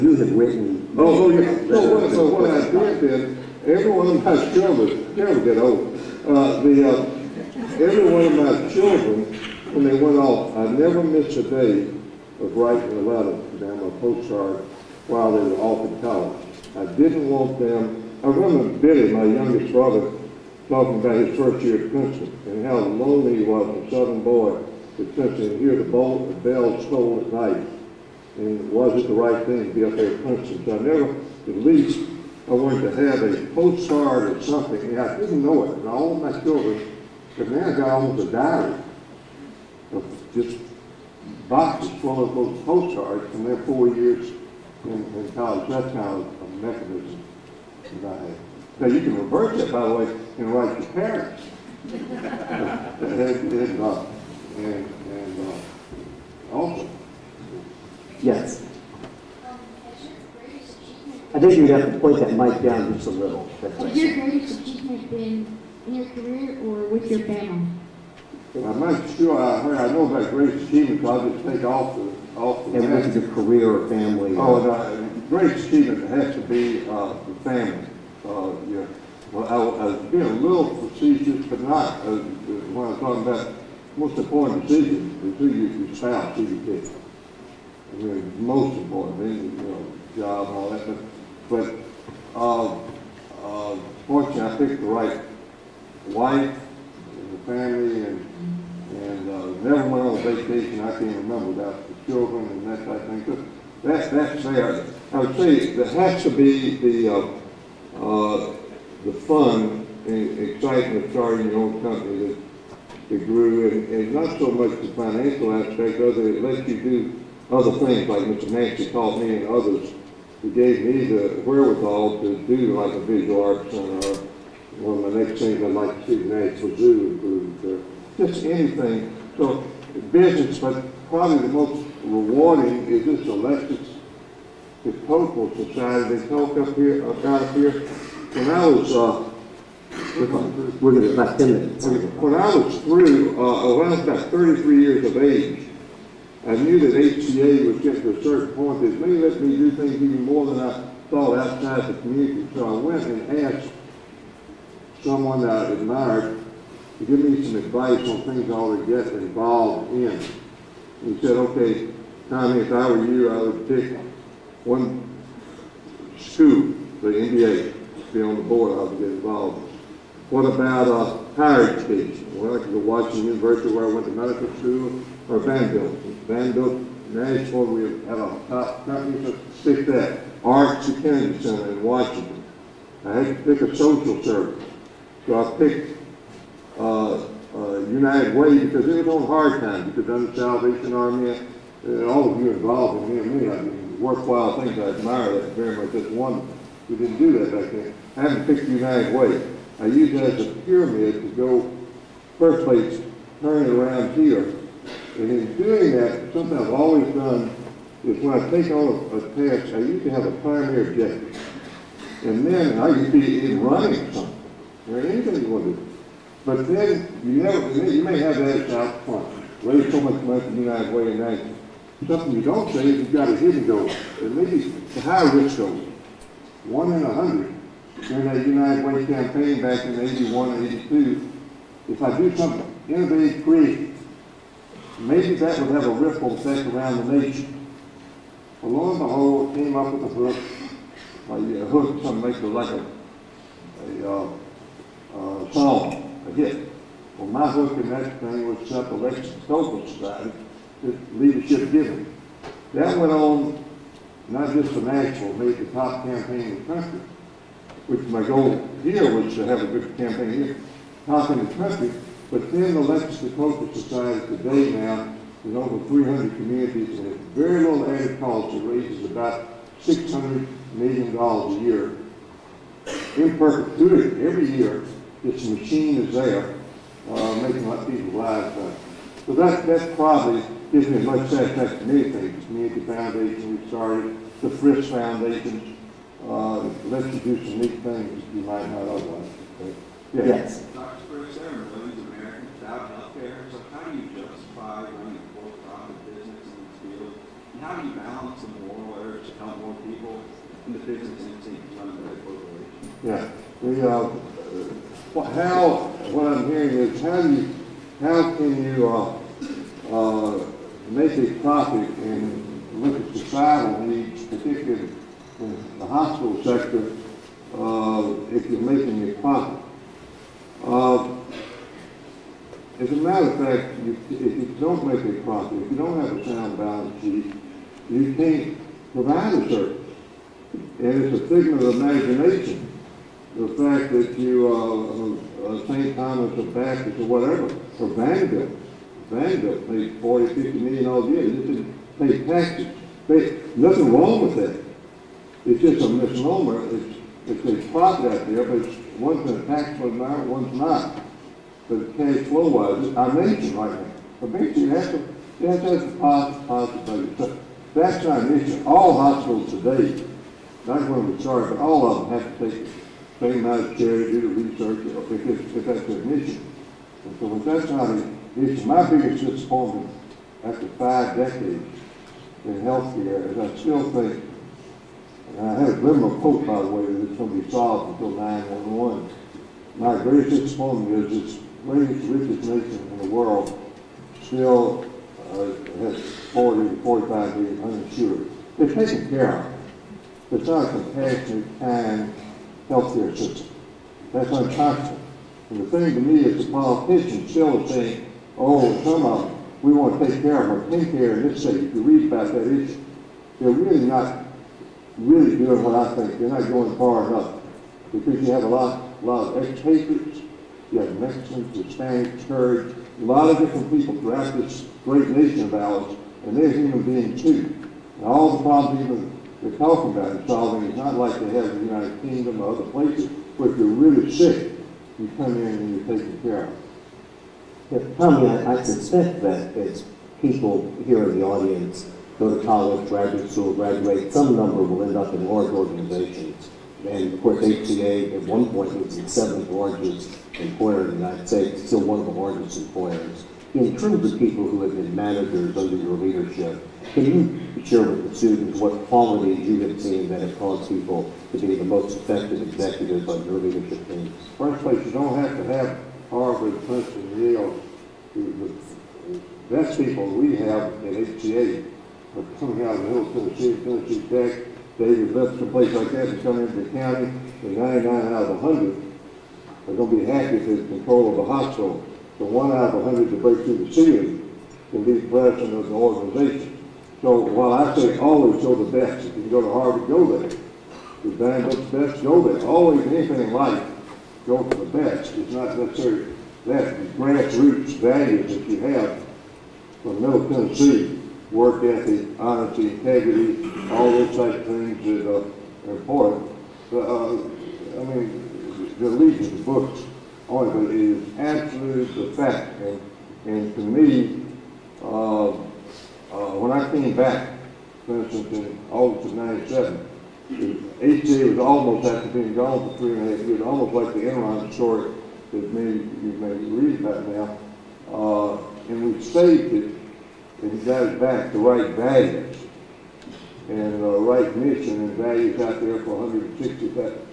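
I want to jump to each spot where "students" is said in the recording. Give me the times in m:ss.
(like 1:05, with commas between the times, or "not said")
7:28.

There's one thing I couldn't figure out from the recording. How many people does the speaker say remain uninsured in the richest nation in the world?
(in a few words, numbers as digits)
40 to 45 million.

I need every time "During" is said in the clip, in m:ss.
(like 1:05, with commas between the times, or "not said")
3:48.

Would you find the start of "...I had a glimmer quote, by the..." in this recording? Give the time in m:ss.
6:15.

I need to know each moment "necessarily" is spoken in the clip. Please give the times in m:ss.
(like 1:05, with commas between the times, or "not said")
8:05.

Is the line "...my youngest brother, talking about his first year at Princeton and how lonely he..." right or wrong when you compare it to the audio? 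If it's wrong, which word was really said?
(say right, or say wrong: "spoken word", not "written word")
right.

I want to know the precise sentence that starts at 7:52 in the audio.
The one out of 100 to break through the ceiling will be the president of the organization.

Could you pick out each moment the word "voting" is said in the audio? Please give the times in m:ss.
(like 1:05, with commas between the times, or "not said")
not said.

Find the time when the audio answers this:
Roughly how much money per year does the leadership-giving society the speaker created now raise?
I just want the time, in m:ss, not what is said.
4:29.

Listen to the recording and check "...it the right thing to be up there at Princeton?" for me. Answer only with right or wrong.
right.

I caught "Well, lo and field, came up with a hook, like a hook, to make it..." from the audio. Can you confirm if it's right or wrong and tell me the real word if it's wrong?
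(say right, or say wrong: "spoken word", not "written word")
wrong: "behold", not "field".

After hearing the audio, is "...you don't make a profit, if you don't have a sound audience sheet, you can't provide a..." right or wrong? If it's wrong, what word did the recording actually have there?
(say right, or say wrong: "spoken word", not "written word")
wrong: "balance", not "audience".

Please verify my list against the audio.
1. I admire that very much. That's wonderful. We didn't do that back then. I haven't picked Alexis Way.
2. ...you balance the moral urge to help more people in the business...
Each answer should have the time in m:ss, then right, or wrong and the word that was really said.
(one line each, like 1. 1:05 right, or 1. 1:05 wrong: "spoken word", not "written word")
1. 3:14 wrong: "United", not "Alexis"
2. 4:57 right.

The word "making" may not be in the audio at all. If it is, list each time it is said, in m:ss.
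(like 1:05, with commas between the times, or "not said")
4:37, 5:18.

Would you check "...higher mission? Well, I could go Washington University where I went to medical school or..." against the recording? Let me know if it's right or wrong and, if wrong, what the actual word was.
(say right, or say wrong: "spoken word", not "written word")
wrong: "education", not "mission".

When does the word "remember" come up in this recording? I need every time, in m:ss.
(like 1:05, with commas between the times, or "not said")
0:18, 1:41.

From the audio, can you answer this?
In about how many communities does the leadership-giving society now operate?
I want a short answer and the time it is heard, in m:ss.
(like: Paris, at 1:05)
over 300, at 4:25.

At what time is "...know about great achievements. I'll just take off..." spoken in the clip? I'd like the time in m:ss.
1:09.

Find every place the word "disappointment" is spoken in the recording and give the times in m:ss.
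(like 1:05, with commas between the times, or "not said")
6:09, 6:20.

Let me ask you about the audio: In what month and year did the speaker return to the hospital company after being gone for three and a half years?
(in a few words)
August 1997.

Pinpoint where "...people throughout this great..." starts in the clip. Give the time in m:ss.
6:53.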